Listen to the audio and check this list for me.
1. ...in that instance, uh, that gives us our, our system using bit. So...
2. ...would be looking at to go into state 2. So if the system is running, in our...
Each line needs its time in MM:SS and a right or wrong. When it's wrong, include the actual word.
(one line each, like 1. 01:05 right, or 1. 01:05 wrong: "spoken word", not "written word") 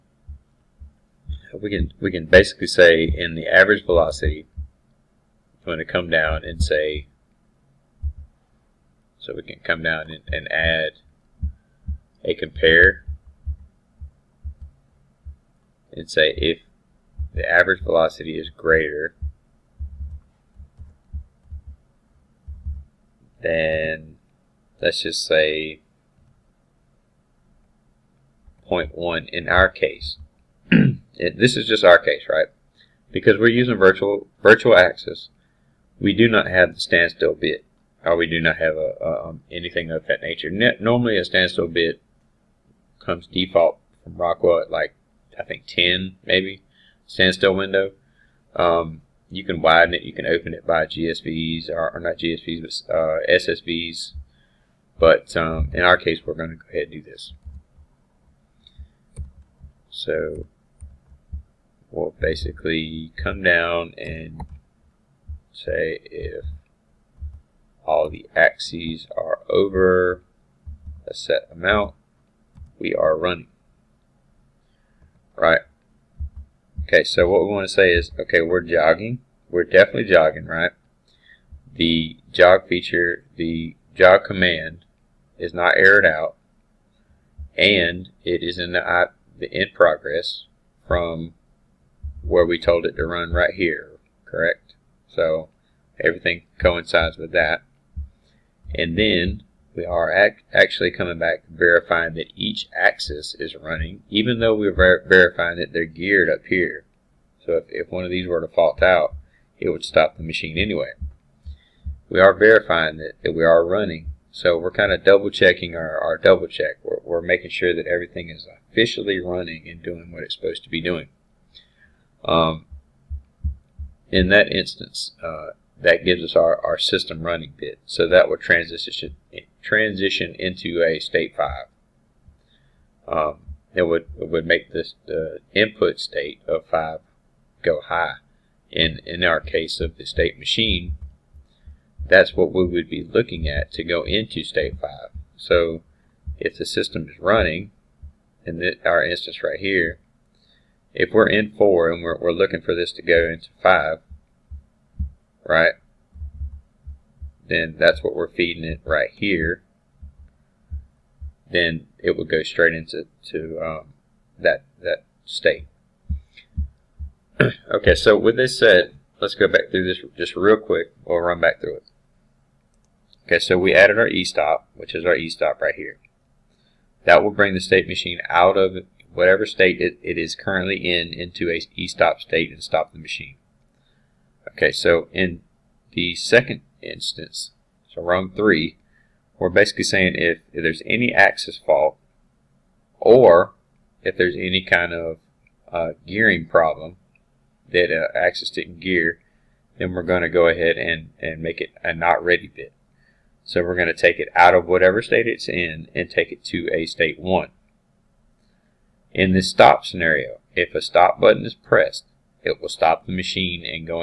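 1. 02:04 wrong: "running", not "using"
2. 02:22 wrong: "5", not "2".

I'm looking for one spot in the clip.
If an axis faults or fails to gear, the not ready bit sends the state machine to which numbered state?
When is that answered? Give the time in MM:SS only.
03:26.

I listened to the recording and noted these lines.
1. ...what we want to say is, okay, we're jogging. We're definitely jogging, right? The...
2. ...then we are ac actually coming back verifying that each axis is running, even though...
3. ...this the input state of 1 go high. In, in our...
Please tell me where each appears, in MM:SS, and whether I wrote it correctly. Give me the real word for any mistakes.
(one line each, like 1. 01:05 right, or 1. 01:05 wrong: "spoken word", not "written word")
1. 01:17 right
2. 01:38 right
3. 02:14 wrong: "5", not "1".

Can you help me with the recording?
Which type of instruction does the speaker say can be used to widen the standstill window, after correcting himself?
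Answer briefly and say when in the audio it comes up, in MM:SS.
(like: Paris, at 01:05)
SSVs, at 00:53.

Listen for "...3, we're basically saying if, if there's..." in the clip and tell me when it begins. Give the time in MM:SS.
03:08.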